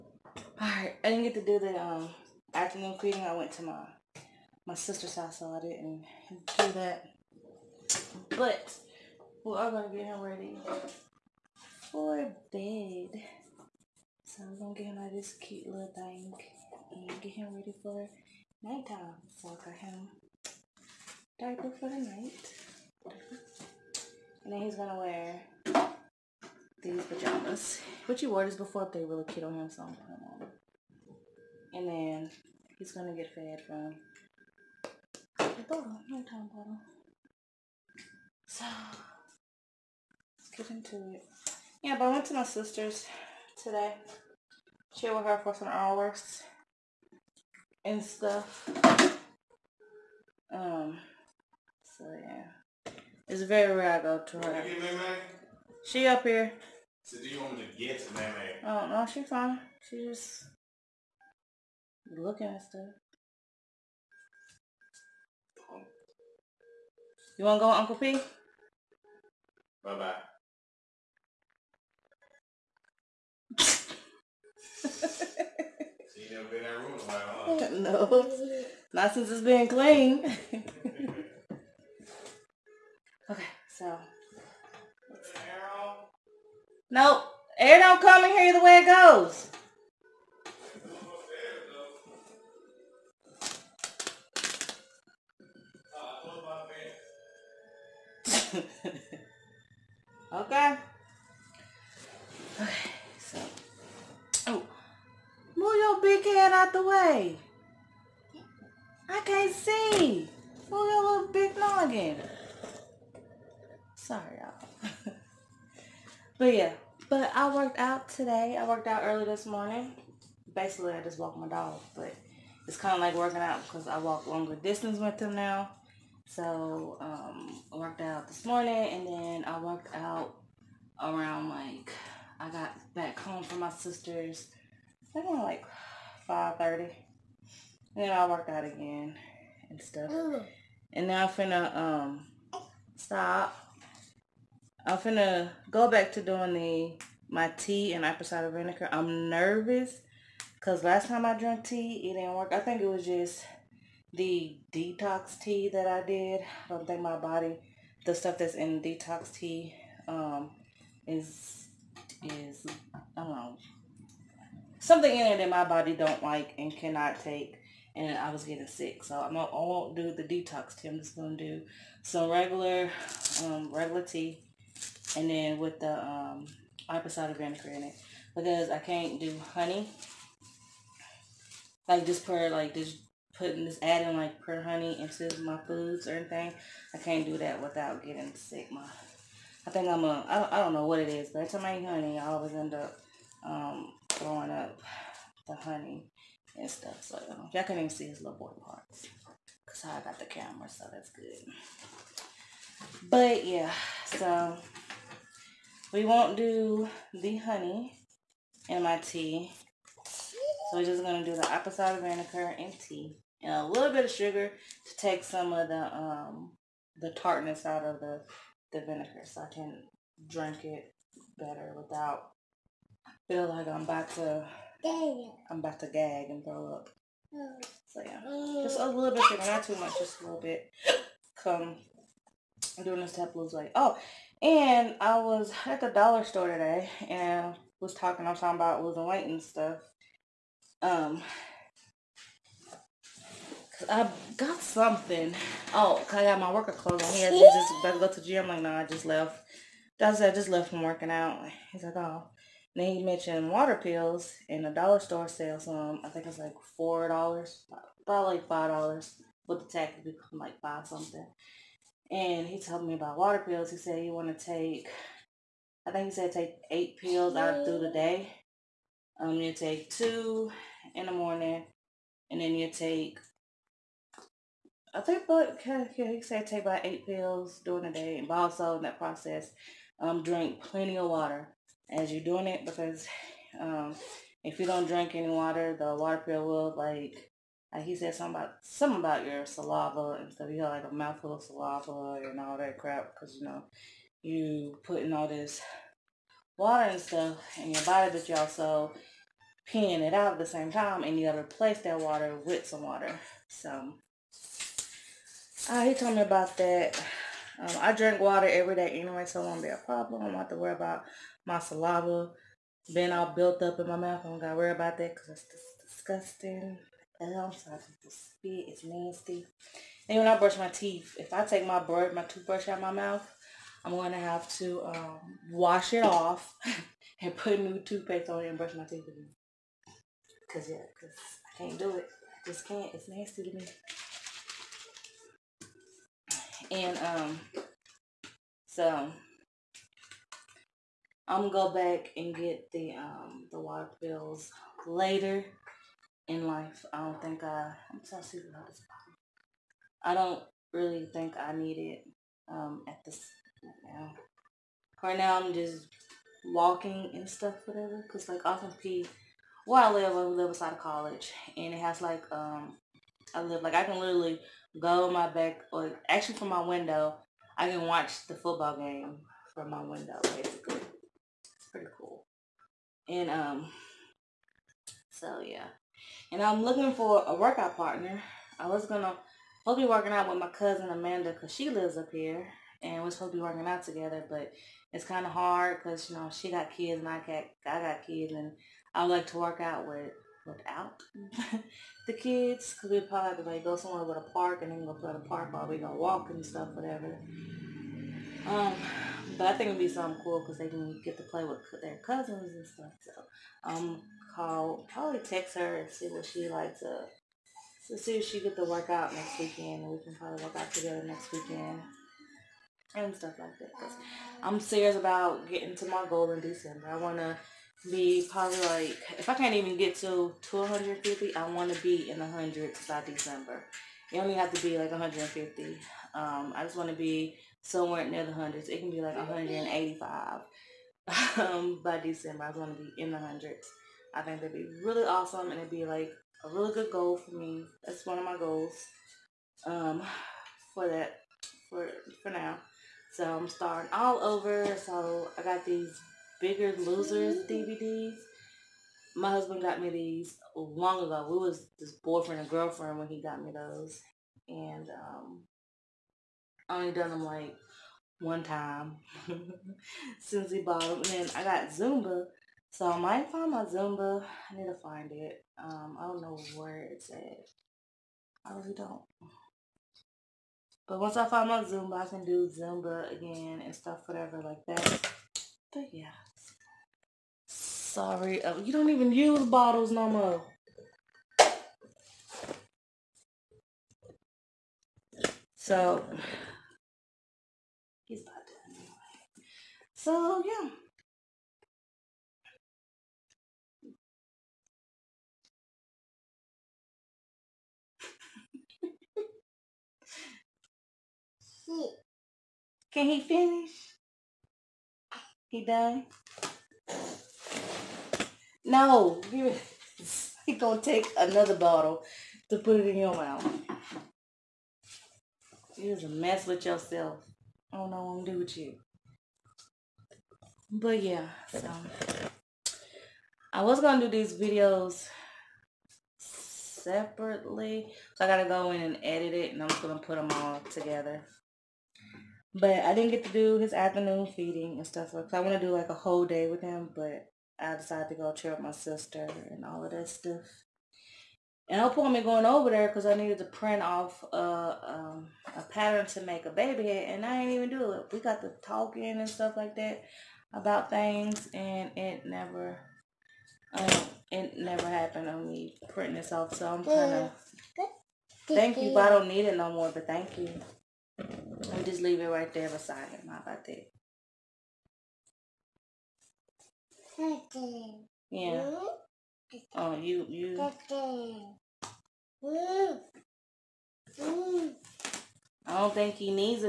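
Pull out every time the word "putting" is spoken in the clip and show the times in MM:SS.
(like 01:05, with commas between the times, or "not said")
00:29, 03:03, 04:54.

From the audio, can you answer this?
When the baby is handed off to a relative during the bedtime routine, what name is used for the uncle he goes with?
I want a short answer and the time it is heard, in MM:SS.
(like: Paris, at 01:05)
Uncle P, at 01:07.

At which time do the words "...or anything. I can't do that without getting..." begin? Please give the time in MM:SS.
03:06.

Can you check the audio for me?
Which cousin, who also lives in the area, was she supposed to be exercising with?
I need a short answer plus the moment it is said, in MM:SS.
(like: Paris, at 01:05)
Amanda, at 06:20.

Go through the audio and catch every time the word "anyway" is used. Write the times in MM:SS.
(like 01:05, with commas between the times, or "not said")
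05:08, 08:08.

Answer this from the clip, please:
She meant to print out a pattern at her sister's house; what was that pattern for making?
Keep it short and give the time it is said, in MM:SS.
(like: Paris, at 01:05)
a baby head, at 09:06.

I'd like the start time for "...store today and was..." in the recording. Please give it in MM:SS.
03:56.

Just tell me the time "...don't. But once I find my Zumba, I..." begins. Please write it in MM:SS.
07:48.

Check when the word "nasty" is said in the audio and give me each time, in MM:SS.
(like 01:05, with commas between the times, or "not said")
05:18, 05:33.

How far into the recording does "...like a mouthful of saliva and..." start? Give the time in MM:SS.
04:50.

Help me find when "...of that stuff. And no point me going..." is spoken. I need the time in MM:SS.
08:59.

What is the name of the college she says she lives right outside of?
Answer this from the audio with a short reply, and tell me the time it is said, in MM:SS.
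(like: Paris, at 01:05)
Austin Peay, at 05:58.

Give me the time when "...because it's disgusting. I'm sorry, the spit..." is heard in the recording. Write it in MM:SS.
05:15.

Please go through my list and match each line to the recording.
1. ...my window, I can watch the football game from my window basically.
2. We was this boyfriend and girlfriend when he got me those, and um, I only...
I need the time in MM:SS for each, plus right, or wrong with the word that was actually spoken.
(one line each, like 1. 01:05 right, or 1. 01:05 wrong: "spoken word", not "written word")
1. 06:06 right
2. 07:31 right.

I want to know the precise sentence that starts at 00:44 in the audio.
Chill with her for some hours and stuff.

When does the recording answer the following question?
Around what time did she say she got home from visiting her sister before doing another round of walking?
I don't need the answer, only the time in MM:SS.
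02:16.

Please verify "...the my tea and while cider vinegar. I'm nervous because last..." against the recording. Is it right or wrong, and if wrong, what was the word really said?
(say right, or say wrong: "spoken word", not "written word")
wrong: "apple", not "while".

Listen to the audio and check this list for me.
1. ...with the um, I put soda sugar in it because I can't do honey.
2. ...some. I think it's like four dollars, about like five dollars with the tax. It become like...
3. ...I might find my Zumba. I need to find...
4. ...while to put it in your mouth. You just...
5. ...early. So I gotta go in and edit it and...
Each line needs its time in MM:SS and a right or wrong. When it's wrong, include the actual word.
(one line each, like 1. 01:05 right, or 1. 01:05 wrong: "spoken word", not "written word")
1. 02:55 wrong: "vinegar", not "sugar"
2. 04:15 right
3. 07:42 right
4. 08:31 wrong: "bottle", not "while"
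5. 08:46 wrong: "separately", not "early".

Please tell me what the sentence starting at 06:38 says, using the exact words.
Um, but I think it'd be something cool because they can get to play with their cousins and stuff.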